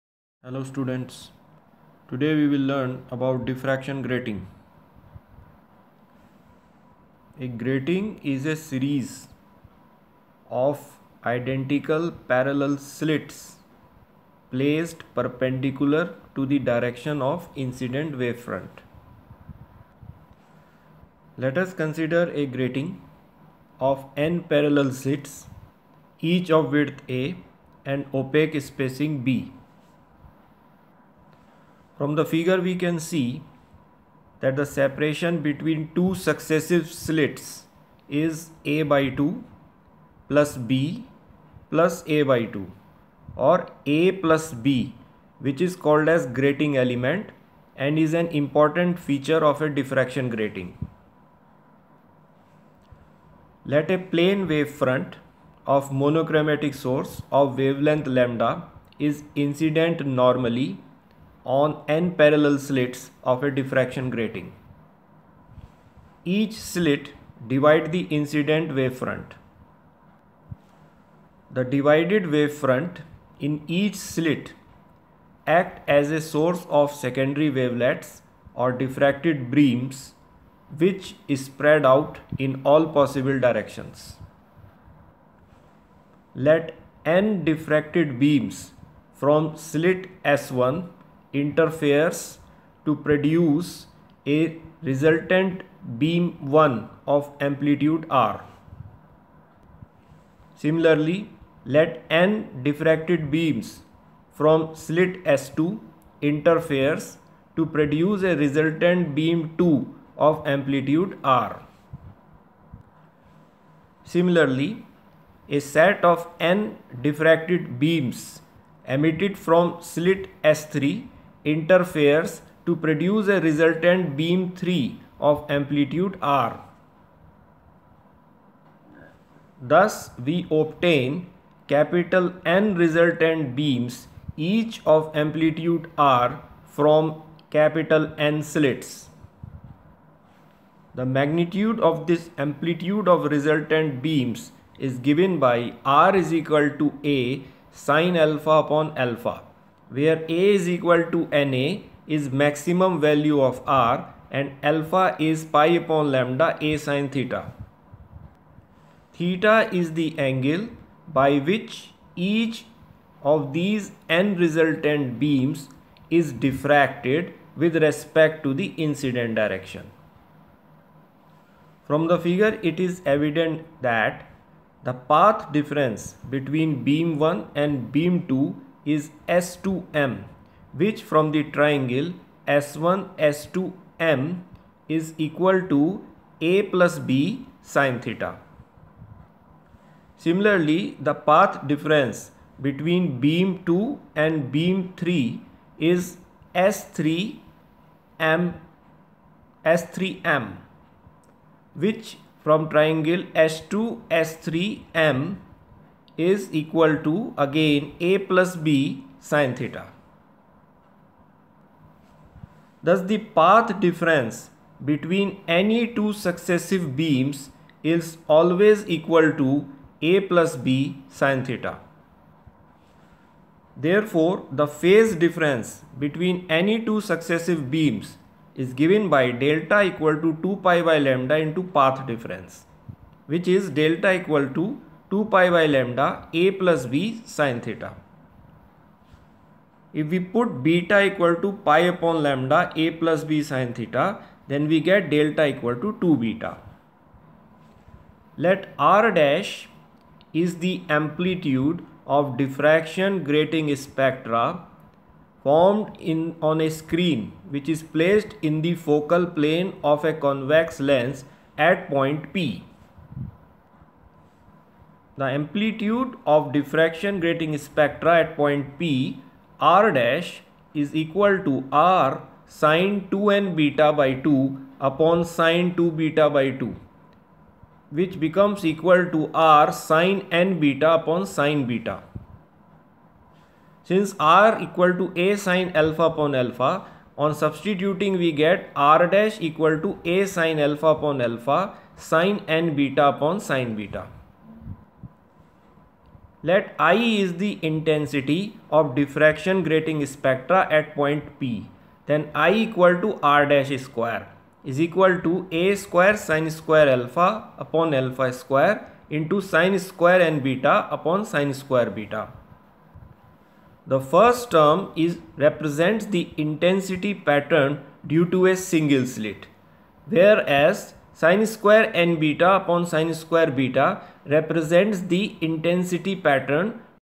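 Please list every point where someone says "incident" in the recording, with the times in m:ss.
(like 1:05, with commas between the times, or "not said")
0:17, 0:59, 1:08, 2:48.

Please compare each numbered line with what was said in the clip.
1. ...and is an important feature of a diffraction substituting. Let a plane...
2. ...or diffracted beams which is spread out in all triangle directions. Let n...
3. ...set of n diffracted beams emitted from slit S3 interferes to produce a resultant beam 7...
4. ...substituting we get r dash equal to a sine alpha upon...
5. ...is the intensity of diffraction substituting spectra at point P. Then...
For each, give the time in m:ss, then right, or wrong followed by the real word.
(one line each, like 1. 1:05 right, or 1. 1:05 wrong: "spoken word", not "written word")
1. 0:47 wrong: "grating", not "substituting"
2. 1:18 wrong: "possible", not "triangle"
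3. 1:55 wrong: "3", not "7"
4. 4:47 right
5. 4:56 wrong: "grating", not "substituting".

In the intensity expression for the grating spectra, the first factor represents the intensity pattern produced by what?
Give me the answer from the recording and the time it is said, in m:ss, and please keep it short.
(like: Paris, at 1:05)
a single slit, at 5:18.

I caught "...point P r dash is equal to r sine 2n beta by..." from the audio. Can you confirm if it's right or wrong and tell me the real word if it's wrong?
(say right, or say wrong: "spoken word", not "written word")
right.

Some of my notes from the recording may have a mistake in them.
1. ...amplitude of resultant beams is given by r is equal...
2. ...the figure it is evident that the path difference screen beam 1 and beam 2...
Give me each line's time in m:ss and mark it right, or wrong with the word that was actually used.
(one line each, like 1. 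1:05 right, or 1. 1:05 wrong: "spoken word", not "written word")
1. 2:22 right
2. 2:52 wrong: "between", not "screen".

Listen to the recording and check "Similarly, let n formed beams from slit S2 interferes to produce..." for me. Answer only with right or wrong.
wrong.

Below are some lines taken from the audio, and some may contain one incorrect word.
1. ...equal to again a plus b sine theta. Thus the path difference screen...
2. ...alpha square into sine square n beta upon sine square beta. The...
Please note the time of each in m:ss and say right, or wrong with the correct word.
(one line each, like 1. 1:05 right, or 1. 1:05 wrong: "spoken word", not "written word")
1. 3:26 wrong: "between", not "screen"
2. 5:07 right.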